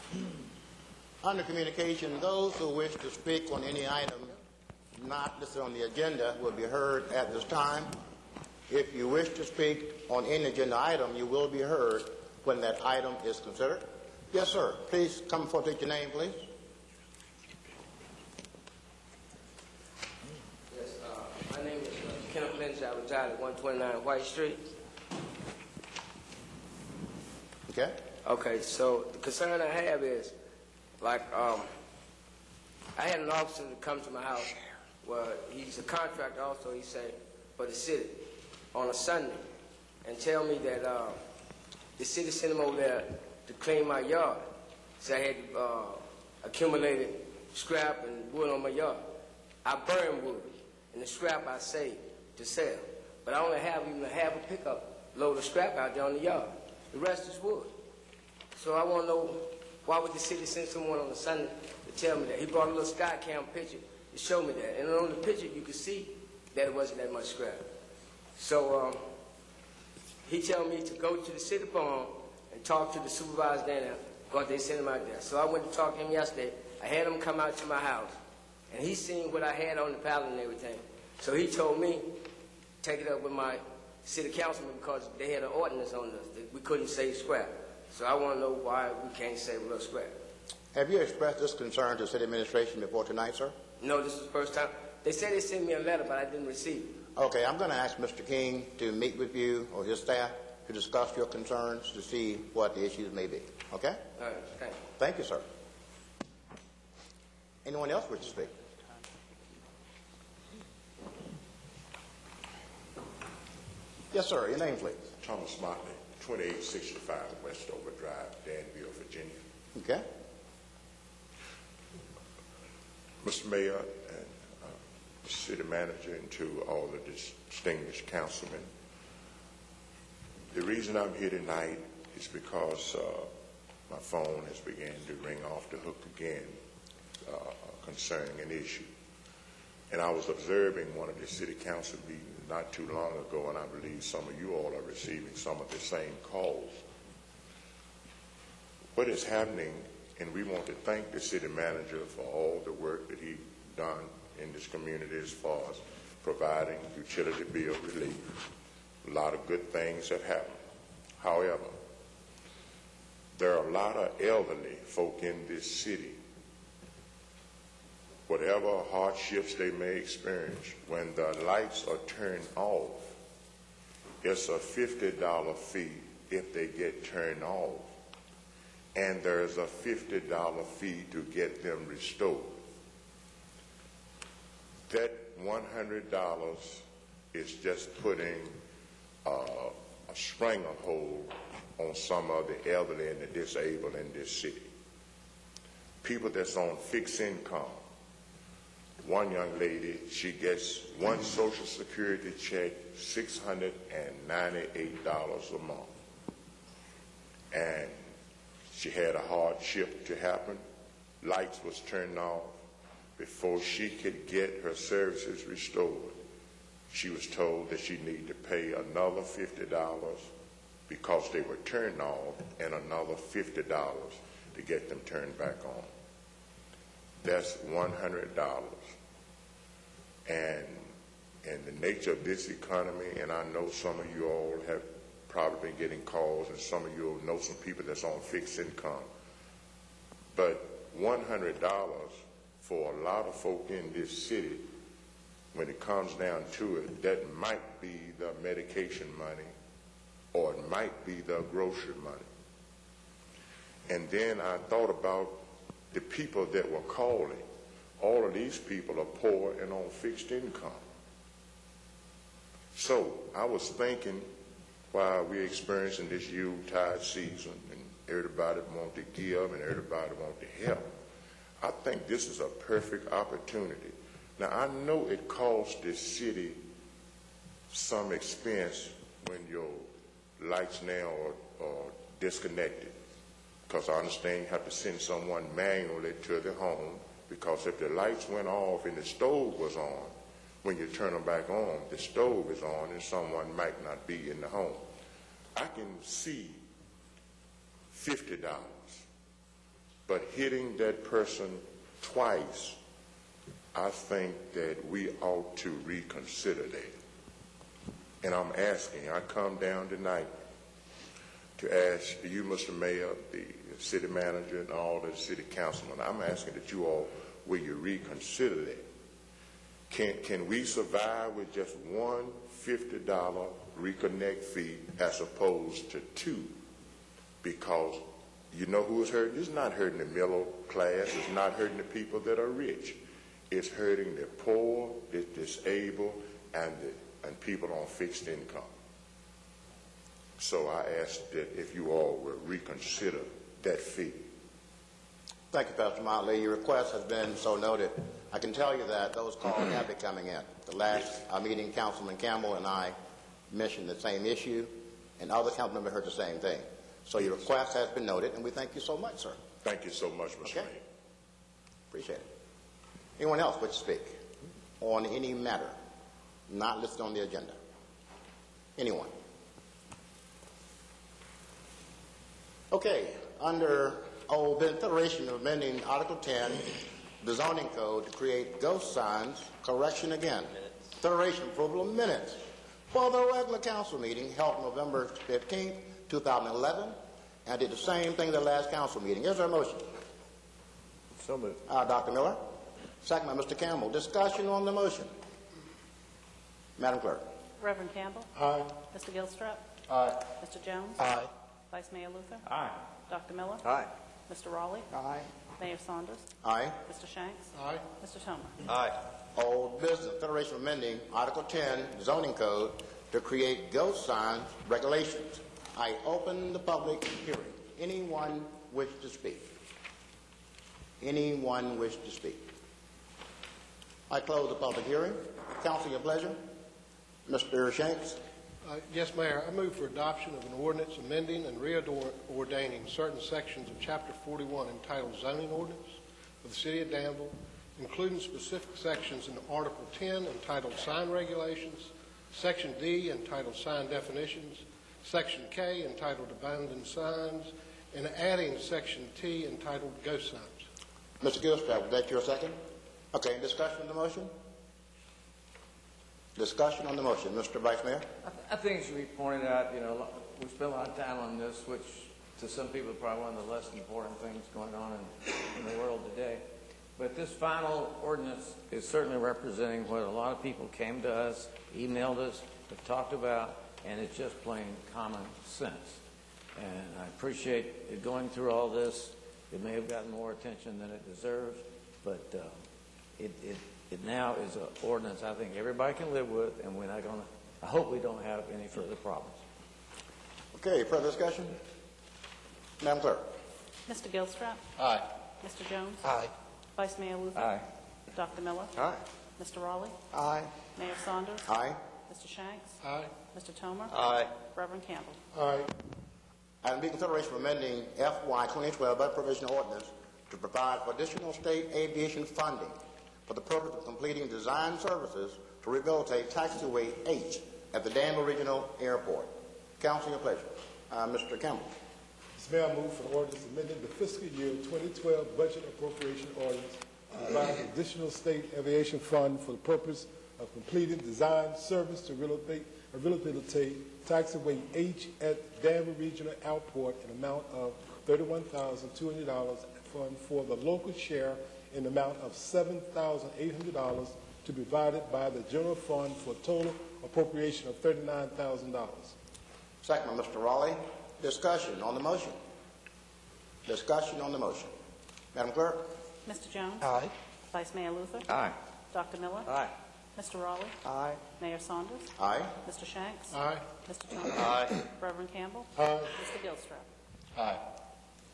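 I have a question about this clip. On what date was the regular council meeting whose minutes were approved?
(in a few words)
November 15, 2011.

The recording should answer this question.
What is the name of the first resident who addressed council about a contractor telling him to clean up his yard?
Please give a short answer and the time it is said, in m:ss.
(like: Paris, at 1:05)
Kenneth Lynch, at 0:22.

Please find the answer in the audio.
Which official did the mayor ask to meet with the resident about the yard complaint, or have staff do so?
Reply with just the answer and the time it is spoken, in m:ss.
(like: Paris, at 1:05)
Mr. King, at 1:37.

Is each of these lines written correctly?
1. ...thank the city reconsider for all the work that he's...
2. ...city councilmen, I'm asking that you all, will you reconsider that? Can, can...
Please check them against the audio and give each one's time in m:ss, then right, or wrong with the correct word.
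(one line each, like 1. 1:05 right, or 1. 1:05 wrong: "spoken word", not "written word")
1. 2:30 wrong: "manager", not "reconsider"
2. 5:15 right.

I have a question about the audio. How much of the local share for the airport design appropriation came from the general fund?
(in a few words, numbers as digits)
$7,800.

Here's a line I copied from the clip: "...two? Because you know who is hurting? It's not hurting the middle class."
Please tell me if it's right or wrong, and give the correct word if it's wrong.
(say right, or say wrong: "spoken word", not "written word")
right.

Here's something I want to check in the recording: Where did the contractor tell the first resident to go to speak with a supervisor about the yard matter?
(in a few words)
the city farm.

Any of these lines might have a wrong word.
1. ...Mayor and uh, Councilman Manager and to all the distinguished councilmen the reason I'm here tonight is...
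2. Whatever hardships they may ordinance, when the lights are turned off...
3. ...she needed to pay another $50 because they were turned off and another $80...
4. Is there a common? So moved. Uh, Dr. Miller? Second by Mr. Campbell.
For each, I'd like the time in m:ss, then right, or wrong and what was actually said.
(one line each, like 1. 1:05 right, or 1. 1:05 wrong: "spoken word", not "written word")
1. 2:03 wrong: "City", not "Councilman"
2. 2:48 wrong: "experience", not "ordinance"
3. 3:37 wrong: "50", not "80"
4. 6:29 wrong: "motion", not "common".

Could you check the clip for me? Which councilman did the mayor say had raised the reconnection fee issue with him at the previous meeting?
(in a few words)
Councilman Campbell.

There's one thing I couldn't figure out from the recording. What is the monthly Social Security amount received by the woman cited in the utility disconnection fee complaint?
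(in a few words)
$698.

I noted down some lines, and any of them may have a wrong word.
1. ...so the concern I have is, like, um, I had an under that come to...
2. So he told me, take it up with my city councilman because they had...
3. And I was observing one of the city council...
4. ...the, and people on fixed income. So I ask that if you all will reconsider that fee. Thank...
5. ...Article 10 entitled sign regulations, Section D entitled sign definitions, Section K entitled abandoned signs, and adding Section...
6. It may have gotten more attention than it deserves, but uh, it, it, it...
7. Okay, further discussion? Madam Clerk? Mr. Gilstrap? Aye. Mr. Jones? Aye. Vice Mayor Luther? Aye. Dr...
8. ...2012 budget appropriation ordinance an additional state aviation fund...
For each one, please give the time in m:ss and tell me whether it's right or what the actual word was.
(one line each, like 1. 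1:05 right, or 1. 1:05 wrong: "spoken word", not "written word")
1. 0:28 wrong: "officer", not "under"
2. 1:21 right
3. 2:19 right
4. 5:36 right
5. 7:19 right
6. 7:59 right
7. 8:10 right
8. 8:44 right.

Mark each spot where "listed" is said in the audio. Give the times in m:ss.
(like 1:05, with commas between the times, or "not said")
0:05, 6:06.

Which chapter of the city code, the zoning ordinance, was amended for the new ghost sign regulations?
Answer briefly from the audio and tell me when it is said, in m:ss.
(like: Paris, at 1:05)
Chapter 41, at 7:13.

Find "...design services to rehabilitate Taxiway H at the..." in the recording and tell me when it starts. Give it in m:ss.
8:34.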